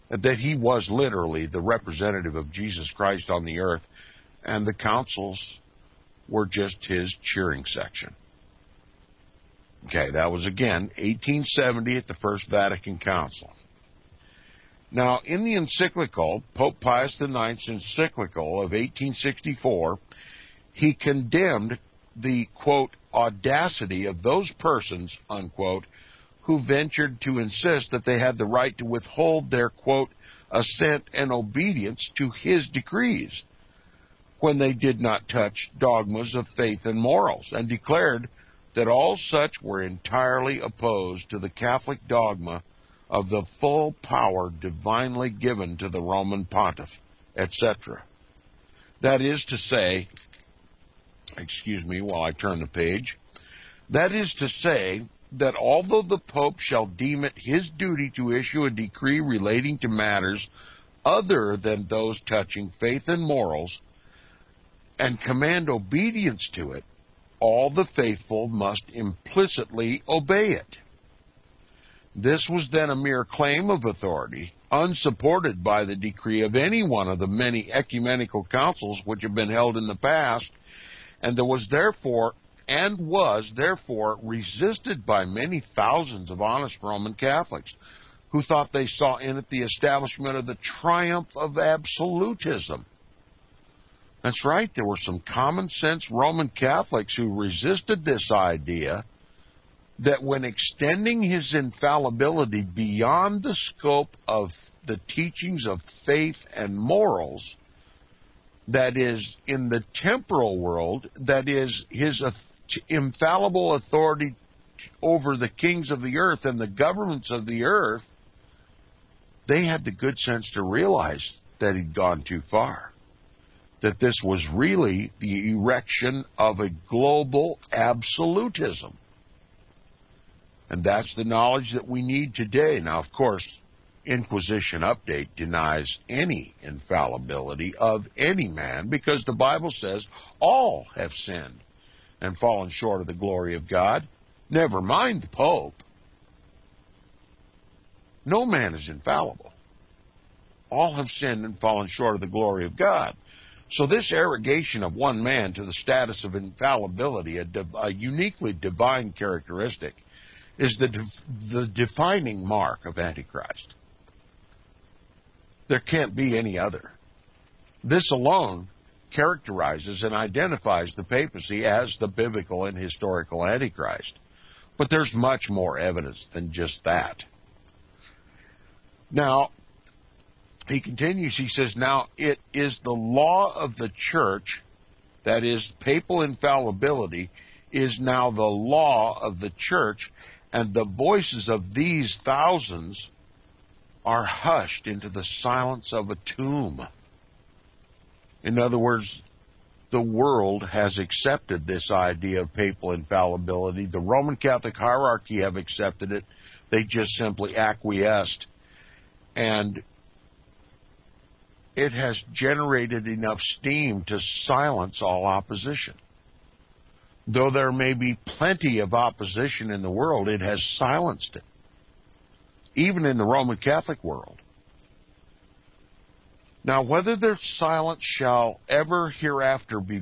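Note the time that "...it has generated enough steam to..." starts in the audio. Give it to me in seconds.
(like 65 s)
211 s.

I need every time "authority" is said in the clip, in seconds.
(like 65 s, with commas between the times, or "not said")
73 s, 113 s.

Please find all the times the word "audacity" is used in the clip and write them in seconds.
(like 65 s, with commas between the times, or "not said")
23 s.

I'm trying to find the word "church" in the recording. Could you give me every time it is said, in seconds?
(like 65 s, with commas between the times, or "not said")
183 s, 189 s.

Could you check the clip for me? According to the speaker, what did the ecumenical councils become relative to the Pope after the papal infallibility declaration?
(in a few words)
His cheering section.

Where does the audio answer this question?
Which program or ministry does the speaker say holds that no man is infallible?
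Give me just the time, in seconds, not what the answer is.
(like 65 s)
134 s.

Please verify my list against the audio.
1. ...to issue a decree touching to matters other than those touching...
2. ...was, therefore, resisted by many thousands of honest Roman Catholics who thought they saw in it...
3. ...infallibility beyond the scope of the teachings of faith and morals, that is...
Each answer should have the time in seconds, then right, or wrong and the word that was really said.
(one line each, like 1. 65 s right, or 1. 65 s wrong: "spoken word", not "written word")
1. 58 s wrong: "relating", not "touching"
2. 82 s right
3. 101 s right.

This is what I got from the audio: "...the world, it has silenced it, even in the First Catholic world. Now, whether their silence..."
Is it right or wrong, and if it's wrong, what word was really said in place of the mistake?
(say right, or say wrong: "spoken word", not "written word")
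wrong: "Roman", not "First".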